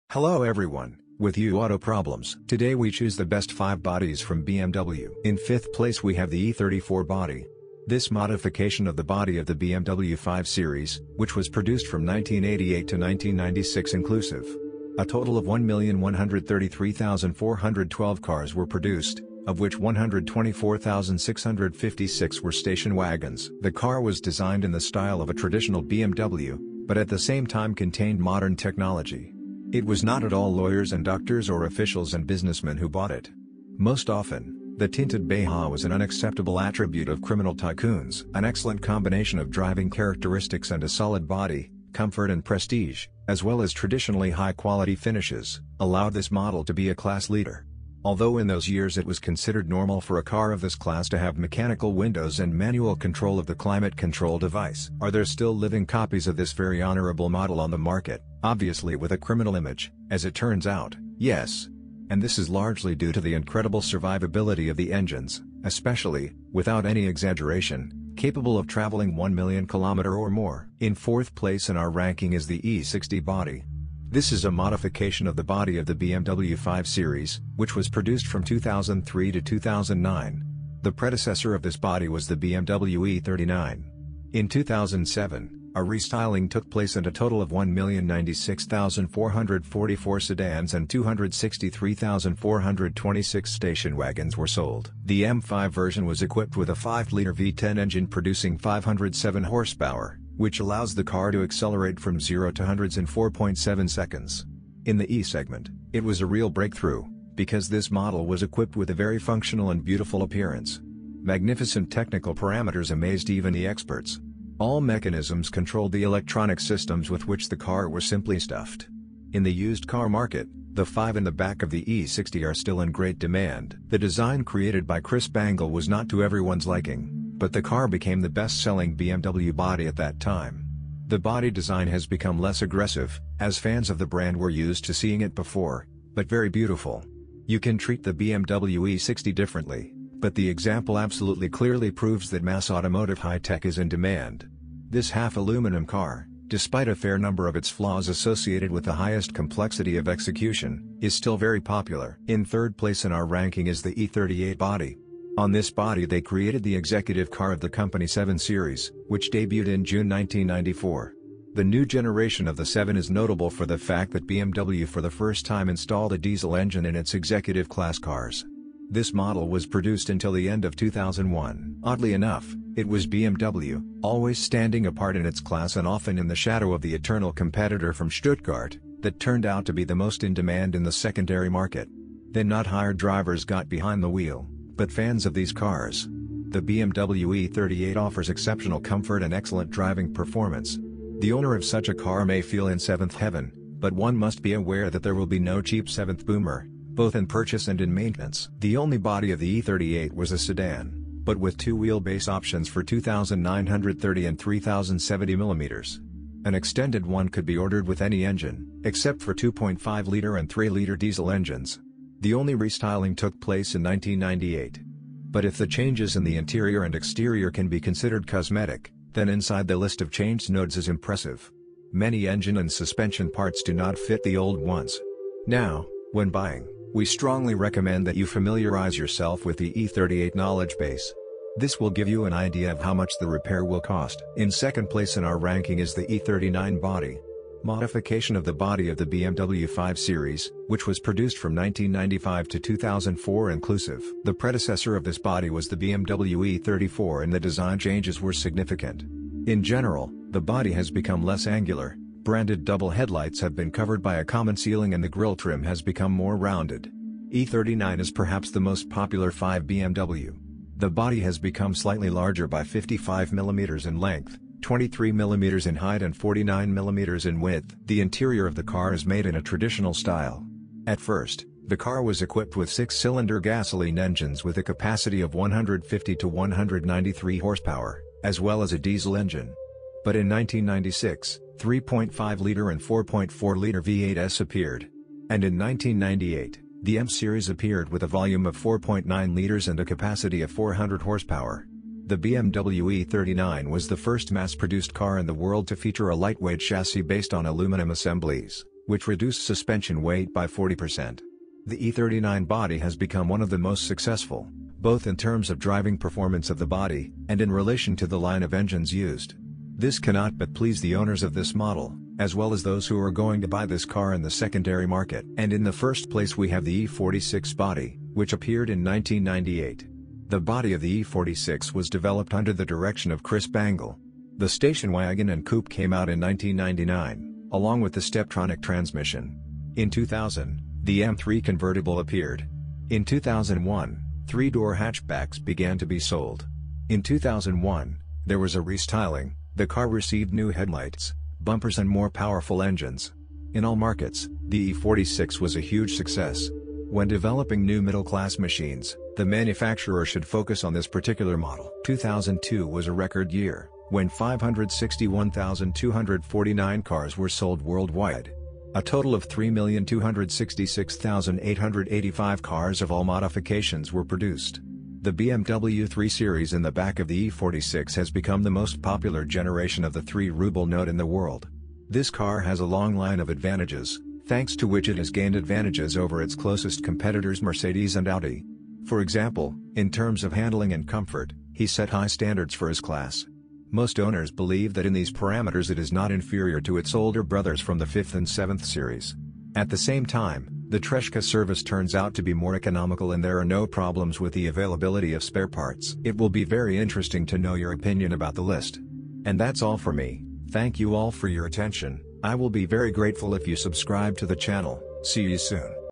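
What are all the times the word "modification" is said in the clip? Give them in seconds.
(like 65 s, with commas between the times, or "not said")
8 s, 74 s, 237 s, 363 s.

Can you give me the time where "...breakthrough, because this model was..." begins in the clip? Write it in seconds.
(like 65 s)
106 s.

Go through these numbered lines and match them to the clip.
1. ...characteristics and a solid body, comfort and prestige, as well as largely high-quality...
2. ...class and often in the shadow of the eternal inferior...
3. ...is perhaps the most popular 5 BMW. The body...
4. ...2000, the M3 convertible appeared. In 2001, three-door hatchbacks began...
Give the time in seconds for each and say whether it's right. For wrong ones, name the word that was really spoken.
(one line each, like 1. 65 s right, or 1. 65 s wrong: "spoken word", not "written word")
1. 39 s wrong: "traditionally", not "largely"
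2. 175 s wrong: "competitor", not "inferior"
3. 257 s right
4. 329 s right.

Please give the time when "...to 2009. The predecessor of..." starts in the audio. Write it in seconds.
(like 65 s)
79 s.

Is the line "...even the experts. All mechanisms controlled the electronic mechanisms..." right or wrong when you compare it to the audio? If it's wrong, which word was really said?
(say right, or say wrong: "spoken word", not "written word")
wrong: "systems", not "mechanisms".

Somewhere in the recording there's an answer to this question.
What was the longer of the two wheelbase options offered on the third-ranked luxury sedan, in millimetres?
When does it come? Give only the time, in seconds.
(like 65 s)
204 s.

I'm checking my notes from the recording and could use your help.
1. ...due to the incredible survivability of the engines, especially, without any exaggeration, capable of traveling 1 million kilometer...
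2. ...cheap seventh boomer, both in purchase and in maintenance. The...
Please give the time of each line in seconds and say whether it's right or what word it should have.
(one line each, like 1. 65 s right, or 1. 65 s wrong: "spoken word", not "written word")
1. 62 s right
2. 195 s right.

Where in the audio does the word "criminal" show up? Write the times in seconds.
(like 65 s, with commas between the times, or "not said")
37 s, 59 s.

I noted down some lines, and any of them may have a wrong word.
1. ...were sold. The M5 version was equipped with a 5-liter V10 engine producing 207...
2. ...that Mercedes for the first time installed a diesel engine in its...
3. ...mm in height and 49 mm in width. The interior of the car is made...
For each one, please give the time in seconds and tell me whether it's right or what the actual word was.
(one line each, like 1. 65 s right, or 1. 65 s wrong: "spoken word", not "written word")
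1. 94 s wrong: "507", not "207"
2. 164 s wrong: "BMW", not "Mercedes"
3. 265 s right.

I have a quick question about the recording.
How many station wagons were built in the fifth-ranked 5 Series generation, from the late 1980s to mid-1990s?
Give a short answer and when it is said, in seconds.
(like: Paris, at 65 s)
124,656, at 19 s.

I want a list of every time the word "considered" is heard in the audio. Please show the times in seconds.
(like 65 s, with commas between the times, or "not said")
49 s, 217 s.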